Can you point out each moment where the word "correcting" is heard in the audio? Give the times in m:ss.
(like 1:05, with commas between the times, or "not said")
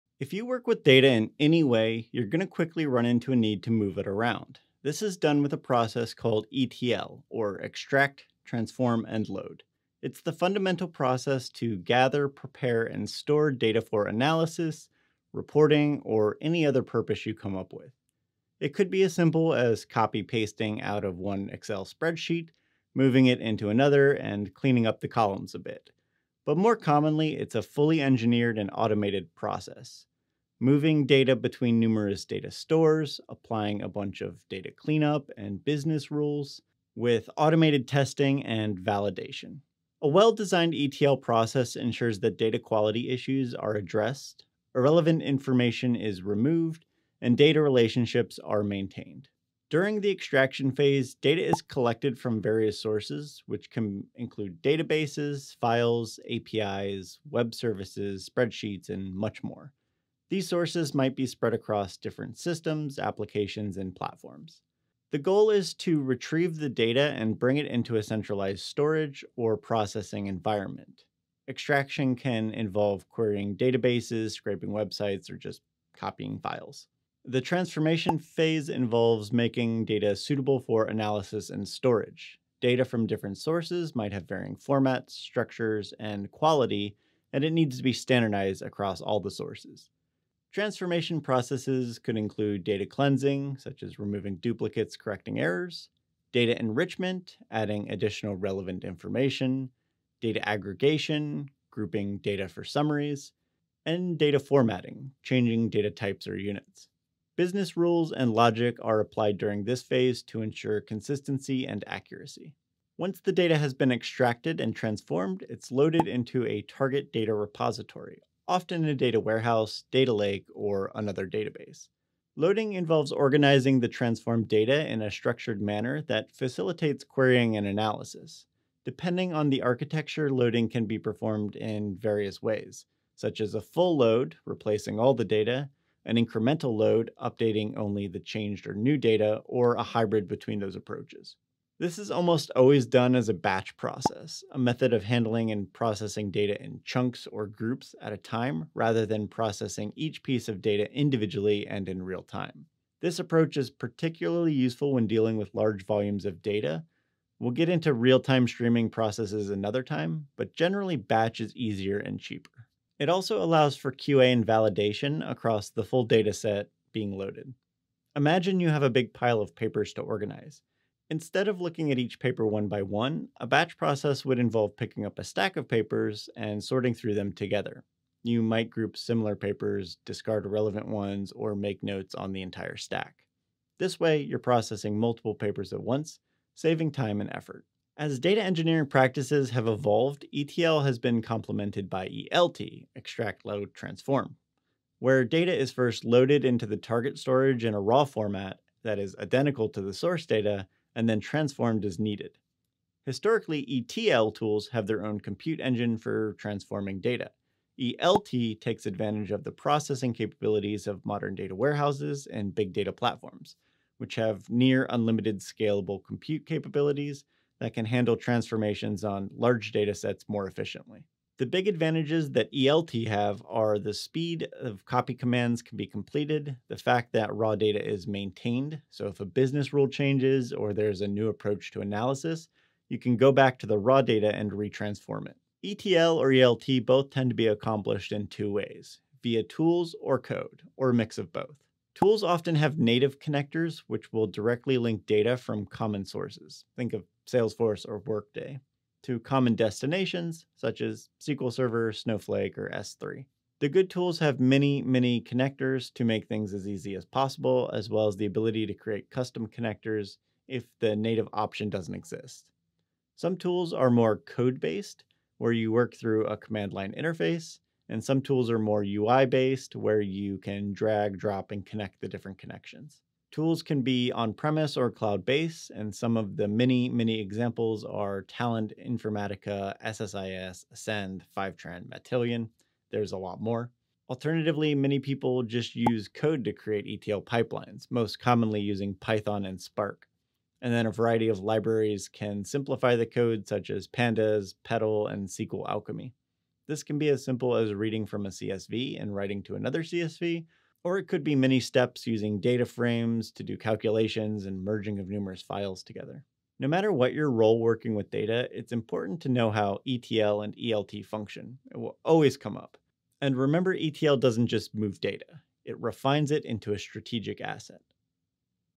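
1:34.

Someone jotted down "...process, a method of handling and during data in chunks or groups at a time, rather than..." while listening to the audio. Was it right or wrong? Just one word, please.
wrong.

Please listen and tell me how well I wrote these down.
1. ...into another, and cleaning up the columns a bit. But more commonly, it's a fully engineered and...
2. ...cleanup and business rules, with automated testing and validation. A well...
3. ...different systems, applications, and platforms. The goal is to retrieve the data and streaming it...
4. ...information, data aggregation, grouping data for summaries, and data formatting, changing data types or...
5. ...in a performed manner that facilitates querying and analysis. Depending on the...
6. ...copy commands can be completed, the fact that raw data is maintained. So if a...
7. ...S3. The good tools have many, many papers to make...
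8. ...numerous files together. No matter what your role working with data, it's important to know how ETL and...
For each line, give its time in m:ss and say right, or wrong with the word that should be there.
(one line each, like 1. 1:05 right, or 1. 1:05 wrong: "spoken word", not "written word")
1. 0:23 right
2. 0:34 right
3. 1:01 wrong: "bring", not "streaming"
4. 1:38 right
5. 2:04 wrong: "structured", not "performed"
6. 3:44 right
7. 4:12 wrong: "connectors", not "papers"
8. 5:05 right.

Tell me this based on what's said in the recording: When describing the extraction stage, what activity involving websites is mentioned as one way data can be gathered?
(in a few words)
scraping websites.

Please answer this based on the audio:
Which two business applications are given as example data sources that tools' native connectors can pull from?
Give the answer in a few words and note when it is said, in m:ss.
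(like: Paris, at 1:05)
Salesforce or Workday, at 4:07.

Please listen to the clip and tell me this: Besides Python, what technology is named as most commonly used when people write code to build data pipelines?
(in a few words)
Spark.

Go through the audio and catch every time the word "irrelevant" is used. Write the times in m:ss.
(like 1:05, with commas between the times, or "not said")
0:44, 3:00.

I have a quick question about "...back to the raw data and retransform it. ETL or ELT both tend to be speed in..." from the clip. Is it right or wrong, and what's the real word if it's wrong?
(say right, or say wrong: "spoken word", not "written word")
wrong: "accomplished", not "speed".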